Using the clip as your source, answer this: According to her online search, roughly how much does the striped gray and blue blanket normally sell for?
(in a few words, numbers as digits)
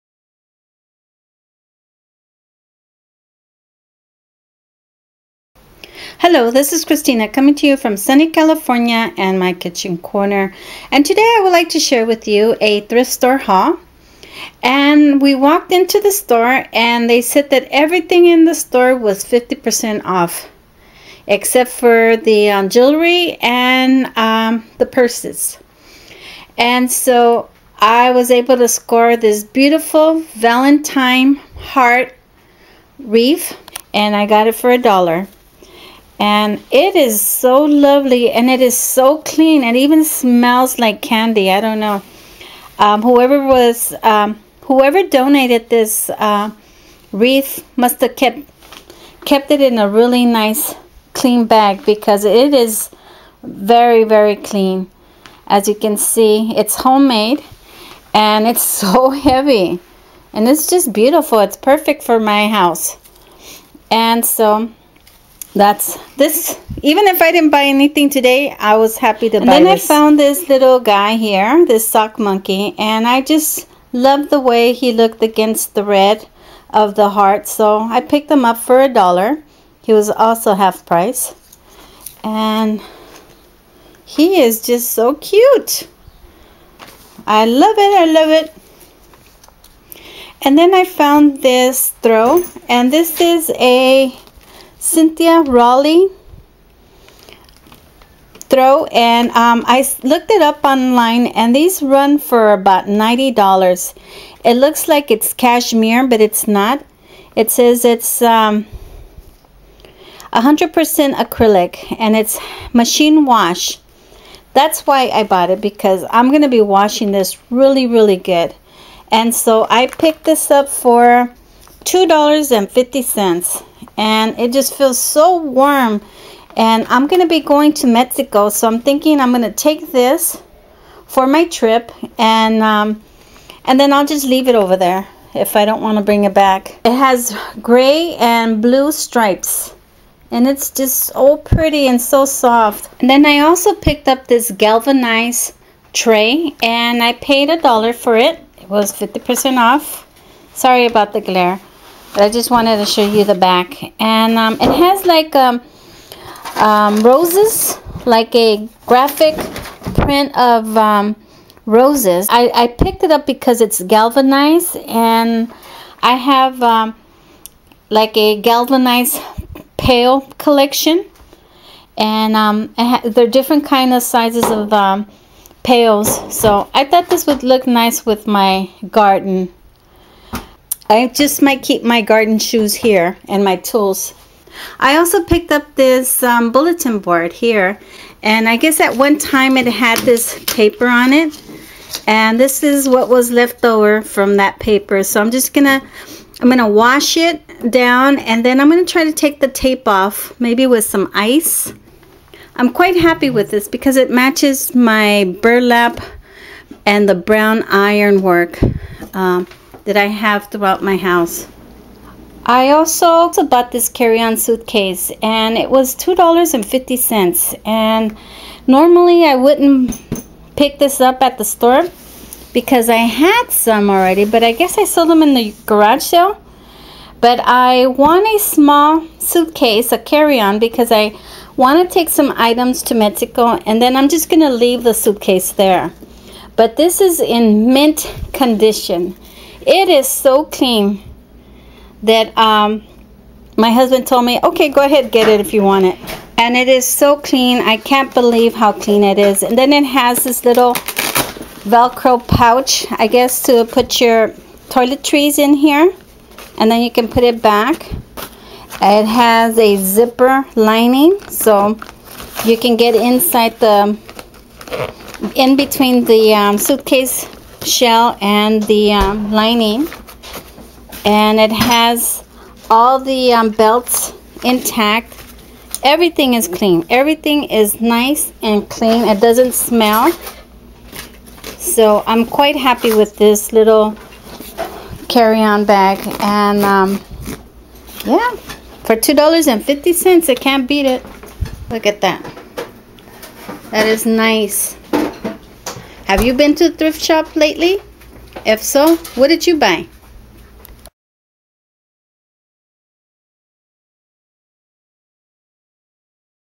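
$90.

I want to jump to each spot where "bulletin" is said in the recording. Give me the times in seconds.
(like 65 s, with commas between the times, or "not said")
186 s.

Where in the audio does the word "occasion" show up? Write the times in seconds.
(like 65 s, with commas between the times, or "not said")
not said.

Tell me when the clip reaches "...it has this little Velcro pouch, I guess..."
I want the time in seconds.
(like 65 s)
249 s.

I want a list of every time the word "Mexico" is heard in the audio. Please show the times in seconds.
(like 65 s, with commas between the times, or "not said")
127 s, 232 s.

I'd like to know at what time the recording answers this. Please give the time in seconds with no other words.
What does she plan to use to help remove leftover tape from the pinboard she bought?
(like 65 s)
201 s.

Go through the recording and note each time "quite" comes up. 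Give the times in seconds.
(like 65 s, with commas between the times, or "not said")
202 s, 282 s.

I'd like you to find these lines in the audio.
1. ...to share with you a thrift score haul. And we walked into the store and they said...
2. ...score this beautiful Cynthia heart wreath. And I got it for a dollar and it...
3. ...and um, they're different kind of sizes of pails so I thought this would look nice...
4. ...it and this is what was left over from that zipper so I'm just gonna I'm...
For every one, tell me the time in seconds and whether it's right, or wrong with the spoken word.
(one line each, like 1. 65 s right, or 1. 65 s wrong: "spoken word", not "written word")
1. 11 s wrong: "store", not "score"
2. 28 s wrong: "Valentine", not "Cynthia"
3. 171 s right
4. 191 s wrong: "paper", not "zipper".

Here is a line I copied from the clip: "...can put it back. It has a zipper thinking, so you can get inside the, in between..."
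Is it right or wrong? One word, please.
wrong.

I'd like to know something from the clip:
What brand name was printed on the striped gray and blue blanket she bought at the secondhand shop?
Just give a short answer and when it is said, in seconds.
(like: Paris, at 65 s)
Cynthia Rowley, at 94 s.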